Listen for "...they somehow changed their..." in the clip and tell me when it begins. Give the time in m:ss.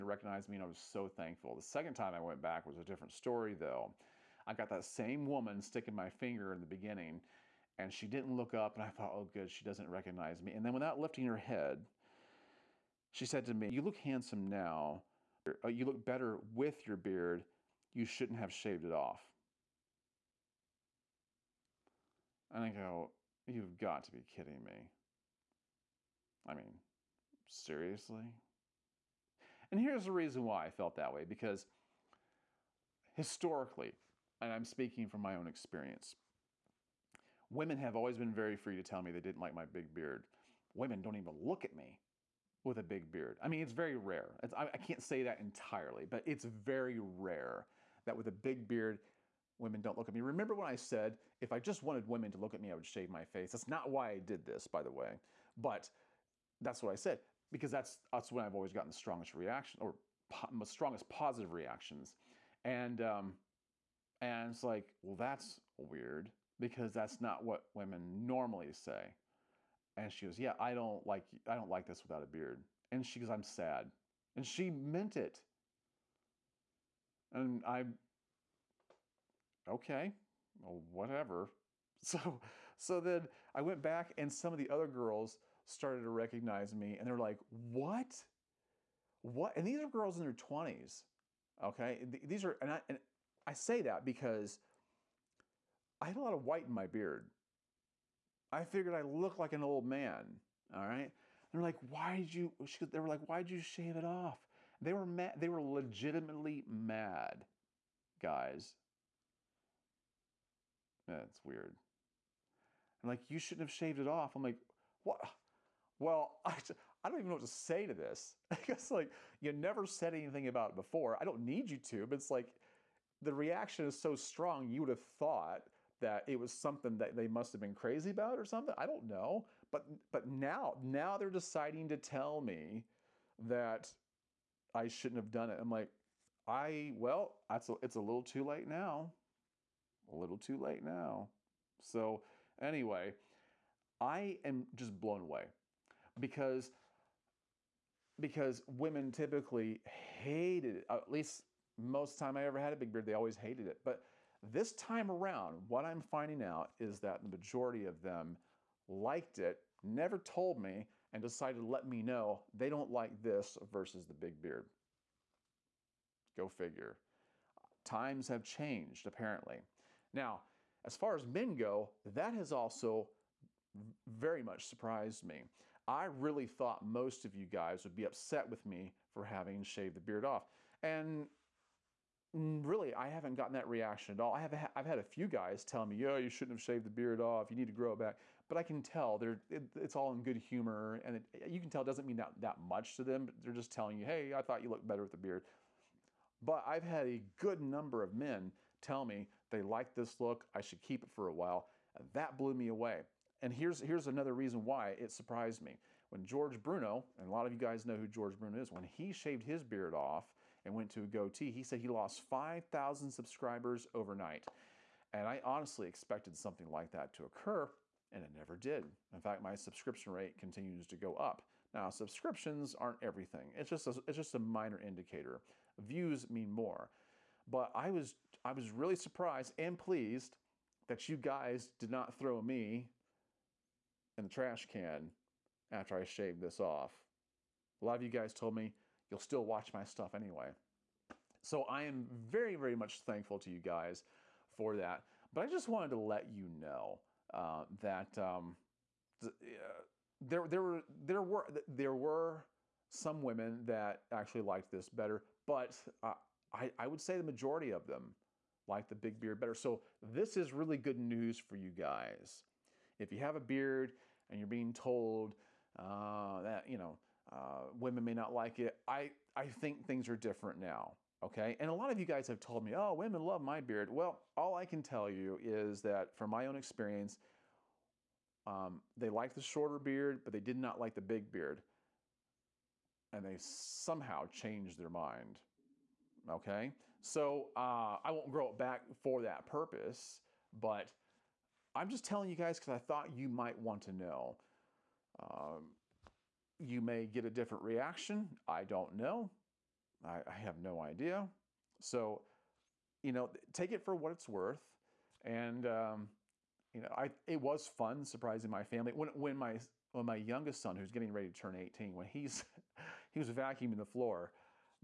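4:43.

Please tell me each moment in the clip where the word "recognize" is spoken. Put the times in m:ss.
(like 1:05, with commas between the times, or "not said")
0:00, 0:09, 1:26.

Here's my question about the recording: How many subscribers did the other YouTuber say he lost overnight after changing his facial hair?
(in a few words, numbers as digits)
5000.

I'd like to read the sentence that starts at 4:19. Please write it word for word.
So this is really good news for you guys.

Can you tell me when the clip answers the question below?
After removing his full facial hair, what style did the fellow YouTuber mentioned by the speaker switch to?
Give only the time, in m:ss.
3:31.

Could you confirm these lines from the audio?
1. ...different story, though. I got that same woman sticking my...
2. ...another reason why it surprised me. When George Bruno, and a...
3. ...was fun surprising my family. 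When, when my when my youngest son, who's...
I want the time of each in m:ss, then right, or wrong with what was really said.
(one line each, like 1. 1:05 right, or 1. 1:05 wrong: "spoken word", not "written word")
1. 0:02 right
2. 3:24 right
3. 5:07 right.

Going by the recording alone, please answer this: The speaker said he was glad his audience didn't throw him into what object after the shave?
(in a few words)
trash can.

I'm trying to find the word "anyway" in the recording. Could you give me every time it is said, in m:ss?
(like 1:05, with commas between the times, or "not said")
2:22, 4:00.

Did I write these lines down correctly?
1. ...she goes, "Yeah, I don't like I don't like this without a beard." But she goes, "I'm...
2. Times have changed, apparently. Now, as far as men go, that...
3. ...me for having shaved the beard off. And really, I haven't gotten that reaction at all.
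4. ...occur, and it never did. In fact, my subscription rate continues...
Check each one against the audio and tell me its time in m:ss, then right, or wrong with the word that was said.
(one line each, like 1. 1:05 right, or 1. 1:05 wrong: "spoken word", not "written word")
1. 1:10 wrong: "And", not "But"
2. 2:47 right
3. 2:58 right
4. 3:37 right.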